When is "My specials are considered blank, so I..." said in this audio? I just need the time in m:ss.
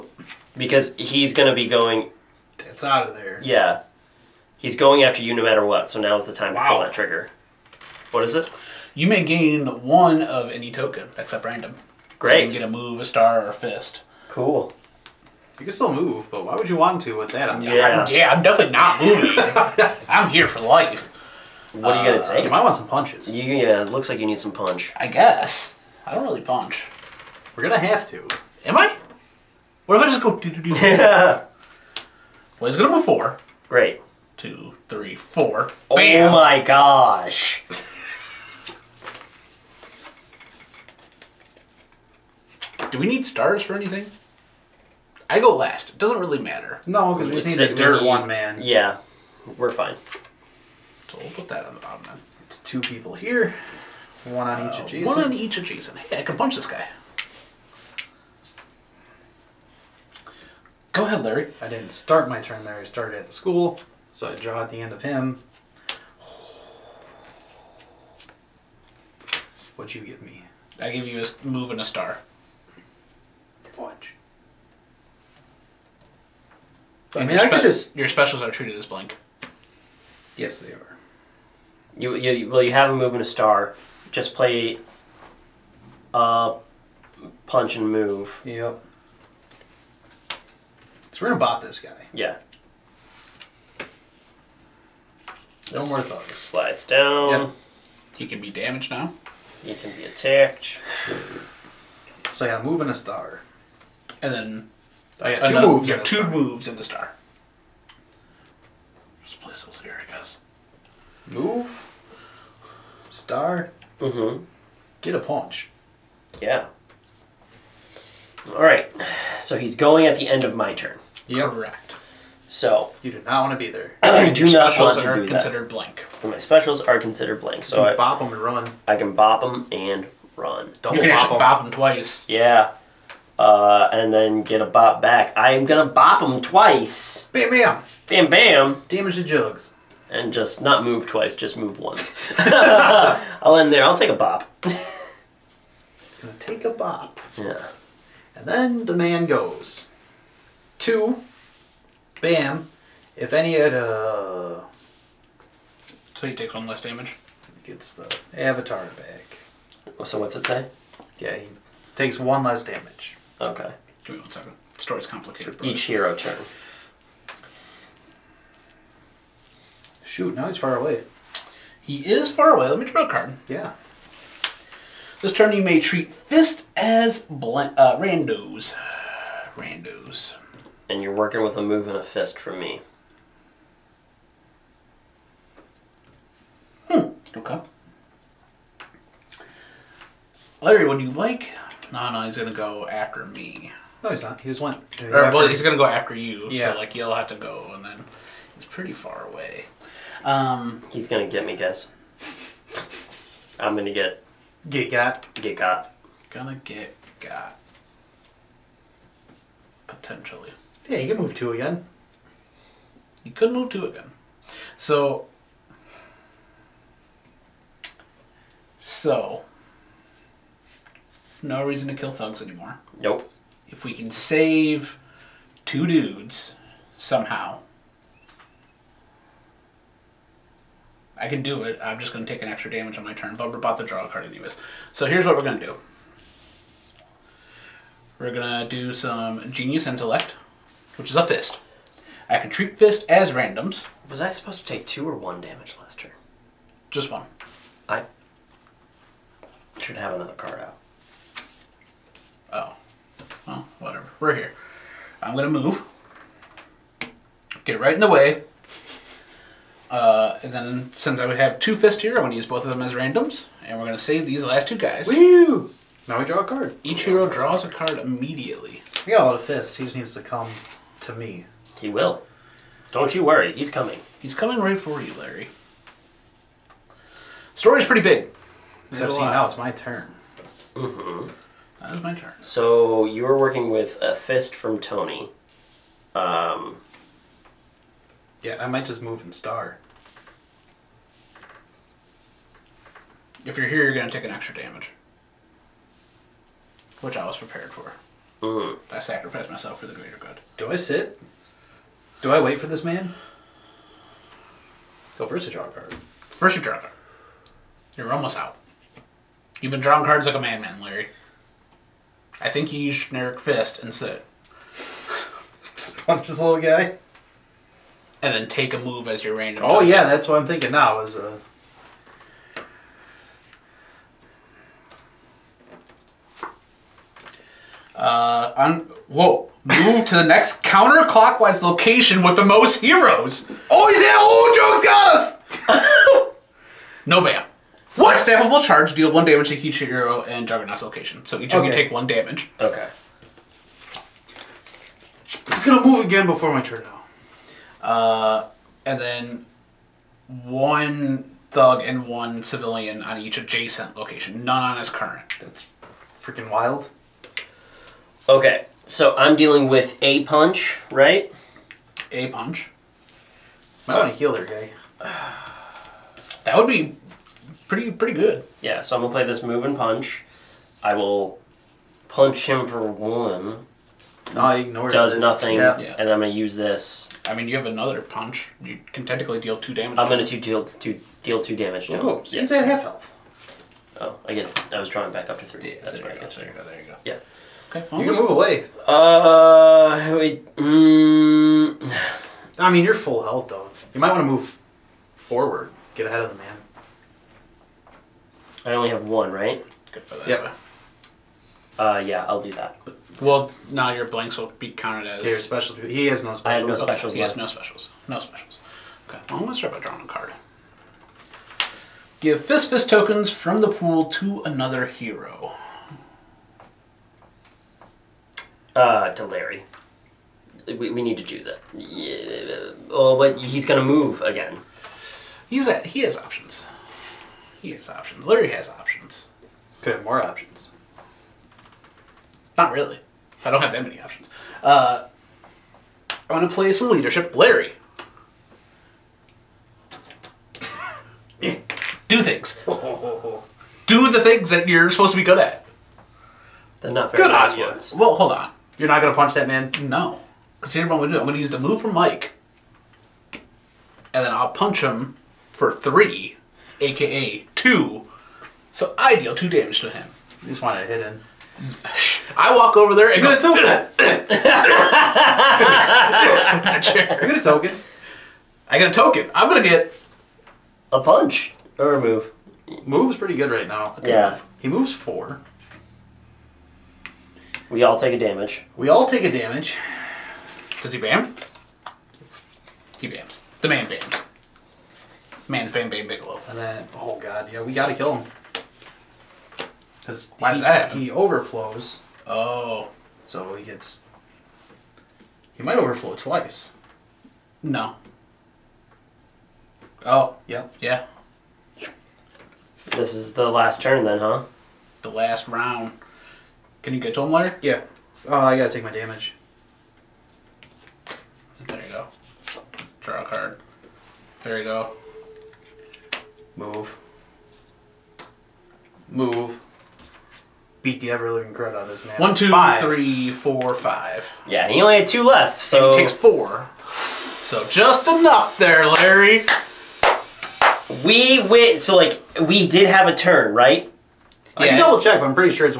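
2:06.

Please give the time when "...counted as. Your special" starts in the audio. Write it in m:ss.
6:44.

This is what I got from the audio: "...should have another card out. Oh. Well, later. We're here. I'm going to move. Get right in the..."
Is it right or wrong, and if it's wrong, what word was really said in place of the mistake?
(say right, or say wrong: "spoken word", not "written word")
wrong: "whatever", not "later".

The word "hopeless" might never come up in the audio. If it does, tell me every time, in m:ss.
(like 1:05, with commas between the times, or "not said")
not said.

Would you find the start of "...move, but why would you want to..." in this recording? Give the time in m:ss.
0:15.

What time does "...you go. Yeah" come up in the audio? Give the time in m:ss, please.
6:26.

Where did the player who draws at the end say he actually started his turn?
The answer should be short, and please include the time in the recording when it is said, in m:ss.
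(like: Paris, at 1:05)
the school, at 1:02.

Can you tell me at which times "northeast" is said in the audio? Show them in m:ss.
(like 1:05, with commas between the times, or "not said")
not said.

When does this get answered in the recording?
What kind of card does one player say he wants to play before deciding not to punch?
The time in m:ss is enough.
7:16.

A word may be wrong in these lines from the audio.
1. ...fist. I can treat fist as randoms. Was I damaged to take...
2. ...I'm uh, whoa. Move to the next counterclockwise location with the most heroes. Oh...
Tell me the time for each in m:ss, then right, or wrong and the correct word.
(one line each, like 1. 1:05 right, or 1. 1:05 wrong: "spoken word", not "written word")
1. 4:01 wrong: "supposed", not "damaged"
2. 5:28 right.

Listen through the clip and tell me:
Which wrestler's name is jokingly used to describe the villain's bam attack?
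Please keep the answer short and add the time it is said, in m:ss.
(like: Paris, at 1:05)
Bam Bam Bigelow, at 8:05.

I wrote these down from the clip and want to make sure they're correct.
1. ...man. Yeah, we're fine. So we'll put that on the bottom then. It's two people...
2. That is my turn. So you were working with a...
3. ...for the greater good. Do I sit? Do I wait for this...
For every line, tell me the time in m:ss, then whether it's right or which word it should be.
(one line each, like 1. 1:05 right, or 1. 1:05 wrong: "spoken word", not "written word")
1. 0:48 right
2. 4:41 right
3. 4:59 right.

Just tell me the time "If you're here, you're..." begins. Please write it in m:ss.
4:53.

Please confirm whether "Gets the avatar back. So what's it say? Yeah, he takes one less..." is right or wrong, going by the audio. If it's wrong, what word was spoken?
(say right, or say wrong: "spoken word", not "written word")
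right.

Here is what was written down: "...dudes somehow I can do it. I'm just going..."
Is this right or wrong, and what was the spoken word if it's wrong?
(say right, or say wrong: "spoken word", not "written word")
right.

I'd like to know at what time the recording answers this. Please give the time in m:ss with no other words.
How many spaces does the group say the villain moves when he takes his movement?
0:32.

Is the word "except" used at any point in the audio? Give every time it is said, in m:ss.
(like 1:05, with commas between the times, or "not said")
0:11, 4:38.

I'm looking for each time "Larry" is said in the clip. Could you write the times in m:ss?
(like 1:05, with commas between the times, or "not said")
1:01, 3:10, 4:35, 5:10, 6:59, 7:08, 7:17, 8:48.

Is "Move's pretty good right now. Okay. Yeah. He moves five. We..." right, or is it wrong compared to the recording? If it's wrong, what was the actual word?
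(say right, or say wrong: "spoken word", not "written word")
wrong: "four", not "five".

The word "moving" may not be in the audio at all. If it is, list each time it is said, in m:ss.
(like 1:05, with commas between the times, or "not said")
0:19.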